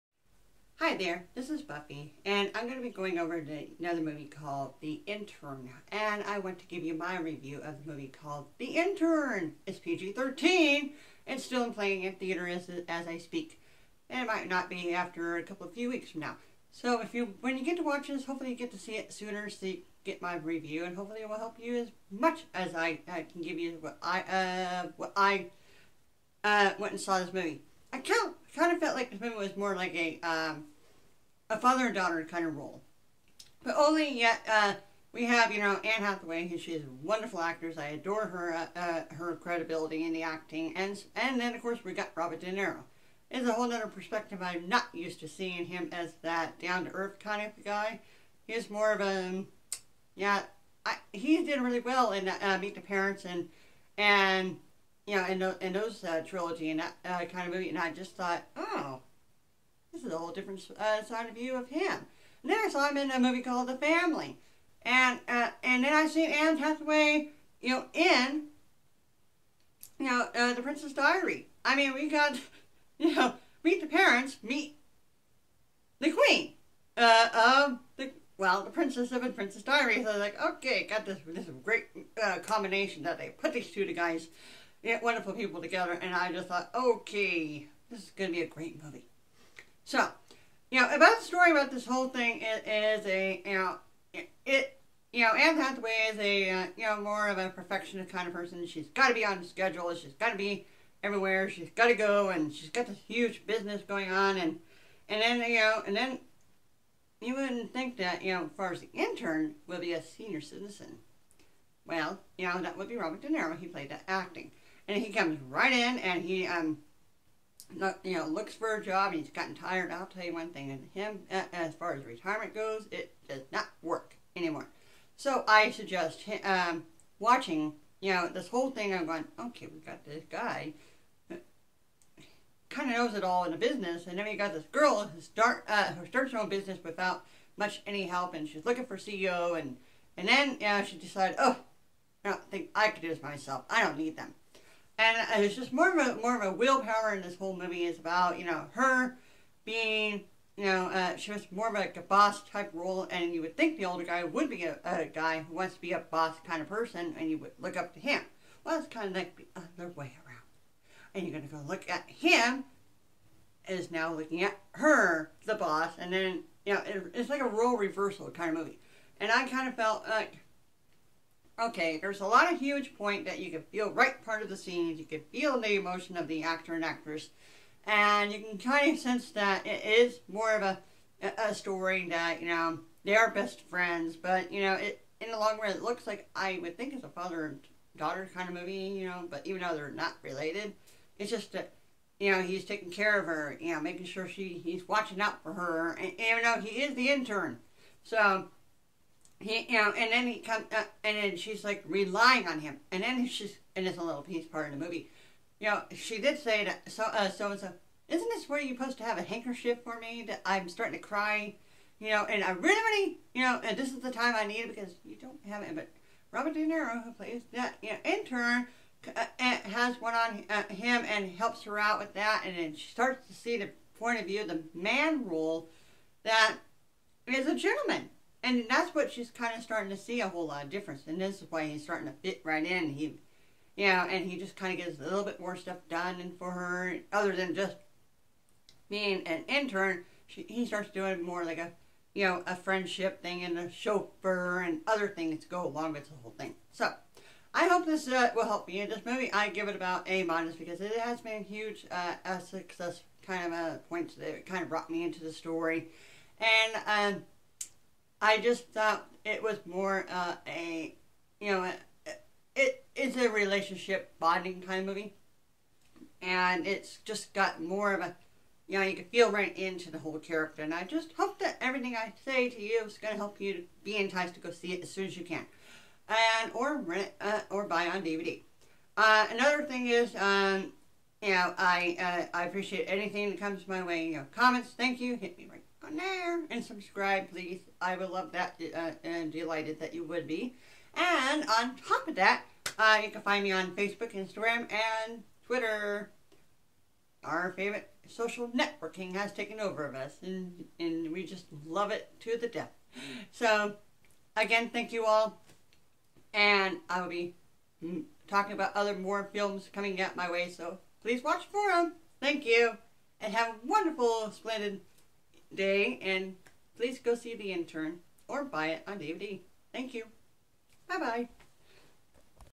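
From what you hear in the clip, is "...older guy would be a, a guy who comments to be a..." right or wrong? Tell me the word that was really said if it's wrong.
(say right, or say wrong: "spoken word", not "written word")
wrong: "wants", not "comments".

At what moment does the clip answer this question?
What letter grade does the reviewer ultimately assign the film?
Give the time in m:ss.
4:10.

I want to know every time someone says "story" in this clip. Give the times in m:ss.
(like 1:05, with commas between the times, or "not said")
1:31, 3:01, 4:15.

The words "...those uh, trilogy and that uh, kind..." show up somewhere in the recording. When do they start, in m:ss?
0:55.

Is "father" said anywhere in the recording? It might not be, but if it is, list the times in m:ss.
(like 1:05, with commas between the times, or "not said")
0:31, 3:07.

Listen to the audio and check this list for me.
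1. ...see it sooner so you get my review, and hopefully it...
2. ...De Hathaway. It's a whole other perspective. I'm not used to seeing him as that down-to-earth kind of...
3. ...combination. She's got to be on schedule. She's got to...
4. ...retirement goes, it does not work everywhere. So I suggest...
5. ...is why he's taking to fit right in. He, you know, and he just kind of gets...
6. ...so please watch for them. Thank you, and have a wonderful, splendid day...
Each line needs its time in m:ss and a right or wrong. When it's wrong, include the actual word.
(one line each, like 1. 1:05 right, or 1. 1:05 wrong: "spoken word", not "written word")
1. 0:18 right
2. 0:42 wrong: "Niro", not "Hathaway"
3. 1:38 wrong: "person", not "combination"
4. 2:02 wrong: "anymore", not "everywhere"
5. 3:51 wrong: "starting", not "taking"
6. 5:10 right.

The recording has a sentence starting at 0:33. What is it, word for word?
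But only yet uh, we have, you know, Anne Hathaway, who she's a wonderful actress.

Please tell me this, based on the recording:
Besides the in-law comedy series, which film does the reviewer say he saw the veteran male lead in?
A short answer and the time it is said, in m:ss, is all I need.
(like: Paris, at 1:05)
The Family, at 1:03.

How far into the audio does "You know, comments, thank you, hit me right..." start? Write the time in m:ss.
4:44.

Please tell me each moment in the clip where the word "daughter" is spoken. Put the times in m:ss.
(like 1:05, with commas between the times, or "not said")
0:31, 3:07.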